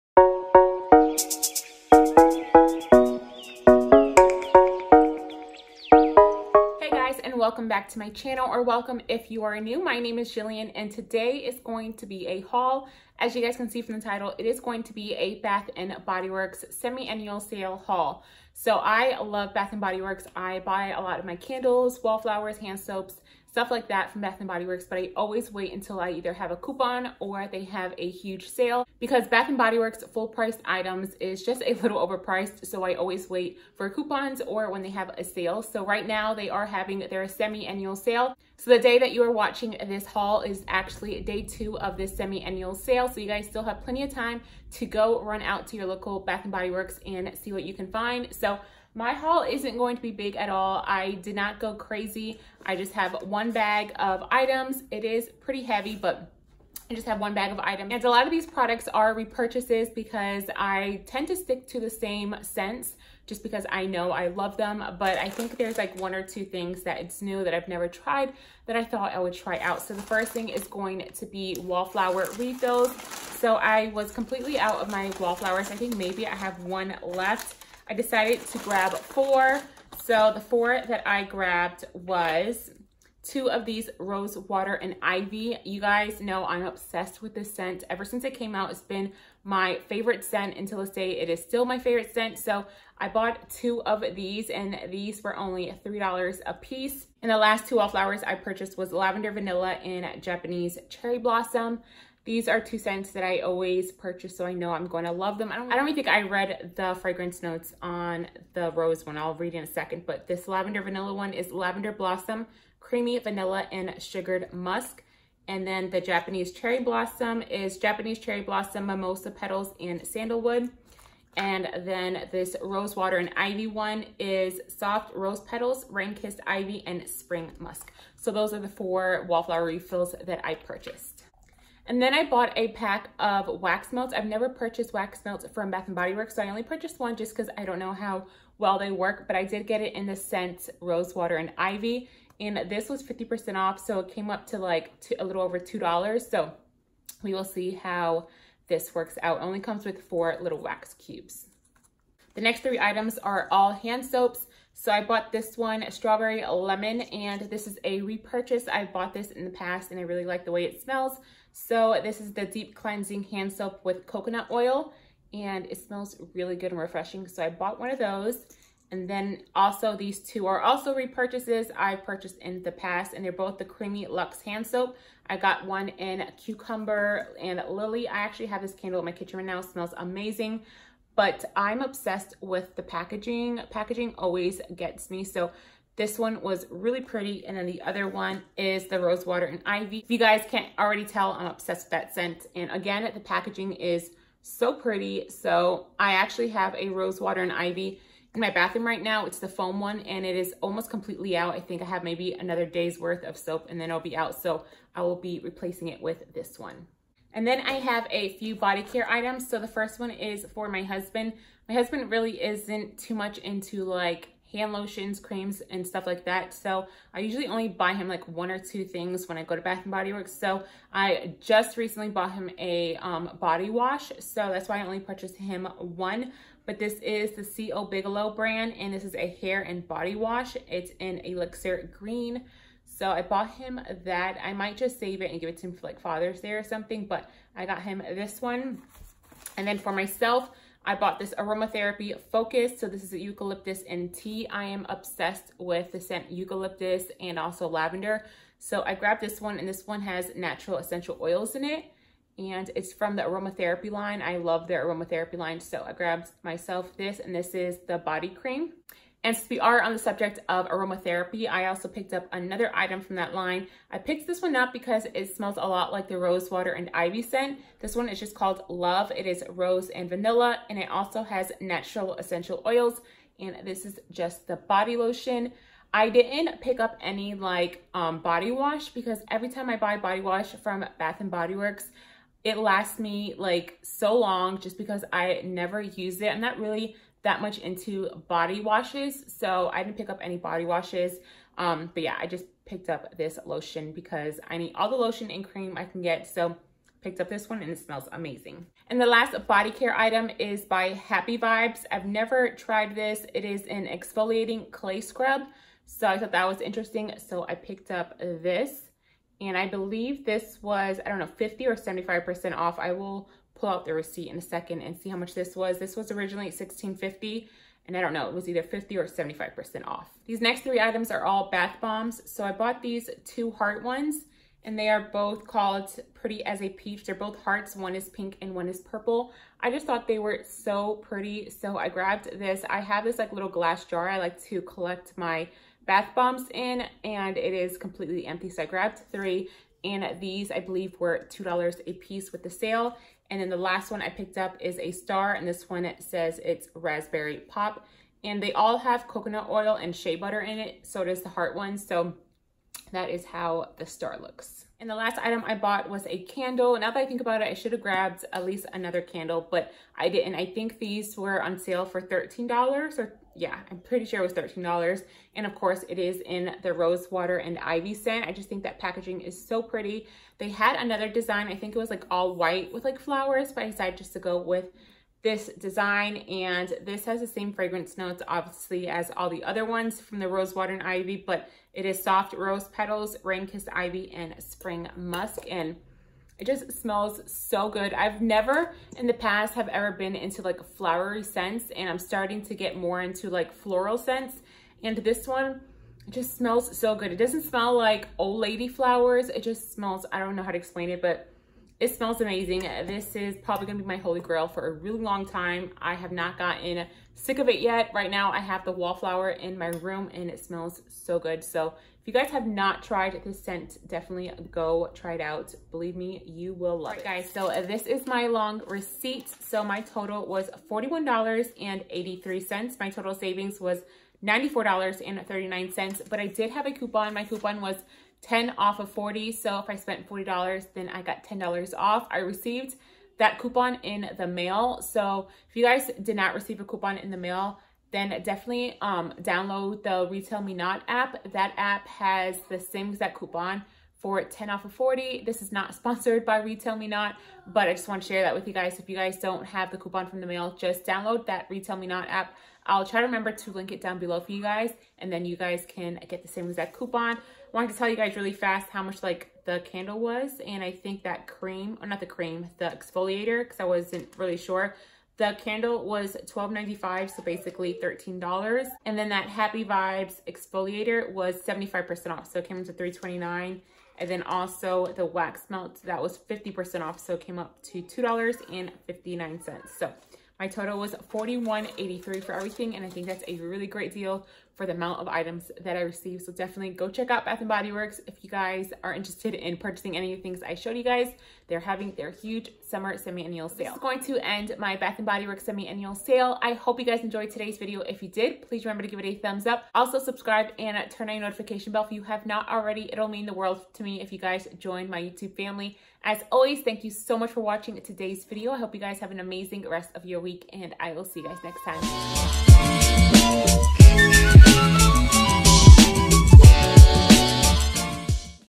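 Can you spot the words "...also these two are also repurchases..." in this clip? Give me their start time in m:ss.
2:49.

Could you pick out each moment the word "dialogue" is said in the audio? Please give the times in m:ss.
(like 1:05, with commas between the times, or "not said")
not said.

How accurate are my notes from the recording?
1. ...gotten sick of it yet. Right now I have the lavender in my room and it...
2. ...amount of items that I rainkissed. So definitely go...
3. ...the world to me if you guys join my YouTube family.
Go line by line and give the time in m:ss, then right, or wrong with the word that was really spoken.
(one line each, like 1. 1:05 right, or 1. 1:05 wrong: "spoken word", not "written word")
1. 6:46 wrong: "wallflower", not "lavender"
2. 8:04 wrong: "received", not "rainkissed"
3. 8:23 right.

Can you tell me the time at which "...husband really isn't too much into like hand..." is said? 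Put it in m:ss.
3:31.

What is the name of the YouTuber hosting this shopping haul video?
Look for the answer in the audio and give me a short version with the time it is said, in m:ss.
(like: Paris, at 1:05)
Jillian, at 0:10.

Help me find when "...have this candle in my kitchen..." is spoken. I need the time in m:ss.
2:58.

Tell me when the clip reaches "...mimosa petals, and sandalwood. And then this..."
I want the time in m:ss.
1:58.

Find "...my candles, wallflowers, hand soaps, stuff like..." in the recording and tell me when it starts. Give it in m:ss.
0:21.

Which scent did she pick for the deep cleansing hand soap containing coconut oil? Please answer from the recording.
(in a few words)
Strawberry Lemon.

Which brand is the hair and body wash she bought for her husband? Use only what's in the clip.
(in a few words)
C.O. Bigelow.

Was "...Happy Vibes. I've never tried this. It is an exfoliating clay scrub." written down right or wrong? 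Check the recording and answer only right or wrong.
right.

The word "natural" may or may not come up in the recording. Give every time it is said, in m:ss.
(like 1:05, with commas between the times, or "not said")
4:10, 4:31.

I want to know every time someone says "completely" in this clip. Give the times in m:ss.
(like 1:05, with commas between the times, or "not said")
1:14, 3:20, 5:37.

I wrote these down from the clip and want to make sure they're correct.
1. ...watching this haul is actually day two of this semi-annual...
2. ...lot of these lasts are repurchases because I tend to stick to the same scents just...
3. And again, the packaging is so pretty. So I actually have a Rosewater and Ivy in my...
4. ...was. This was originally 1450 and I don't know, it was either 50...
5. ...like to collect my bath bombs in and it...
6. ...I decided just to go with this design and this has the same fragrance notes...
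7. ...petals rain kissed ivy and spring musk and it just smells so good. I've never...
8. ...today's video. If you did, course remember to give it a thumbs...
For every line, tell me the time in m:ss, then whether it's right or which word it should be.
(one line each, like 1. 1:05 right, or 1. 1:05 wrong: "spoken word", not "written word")
1. 0:39 right
2. 0:58 wrong: "products", not "lasts"
3. 3:12 right
4. 5:15 wrong: "1650", not "1450"
5. 5:34 right
6. 6:13 right
7. 6:22 right
8. 8:17 wrong: "please", not "course".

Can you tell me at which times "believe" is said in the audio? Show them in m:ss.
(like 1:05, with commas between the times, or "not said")
5:09, 5:40, 6:55.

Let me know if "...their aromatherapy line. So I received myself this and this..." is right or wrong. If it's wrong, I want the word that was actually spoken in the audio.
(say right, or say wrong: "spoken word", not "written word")
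wrong: "grabbed", not "received".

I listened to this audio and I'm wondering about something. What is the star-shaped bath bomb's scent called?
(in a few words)
raspberry pop.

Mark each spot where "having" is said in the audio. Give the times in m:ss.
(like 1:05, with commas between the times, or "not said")
0:36, 8:11.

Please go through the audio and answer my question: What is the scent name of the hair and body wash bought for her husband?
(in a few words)
Elixir Green.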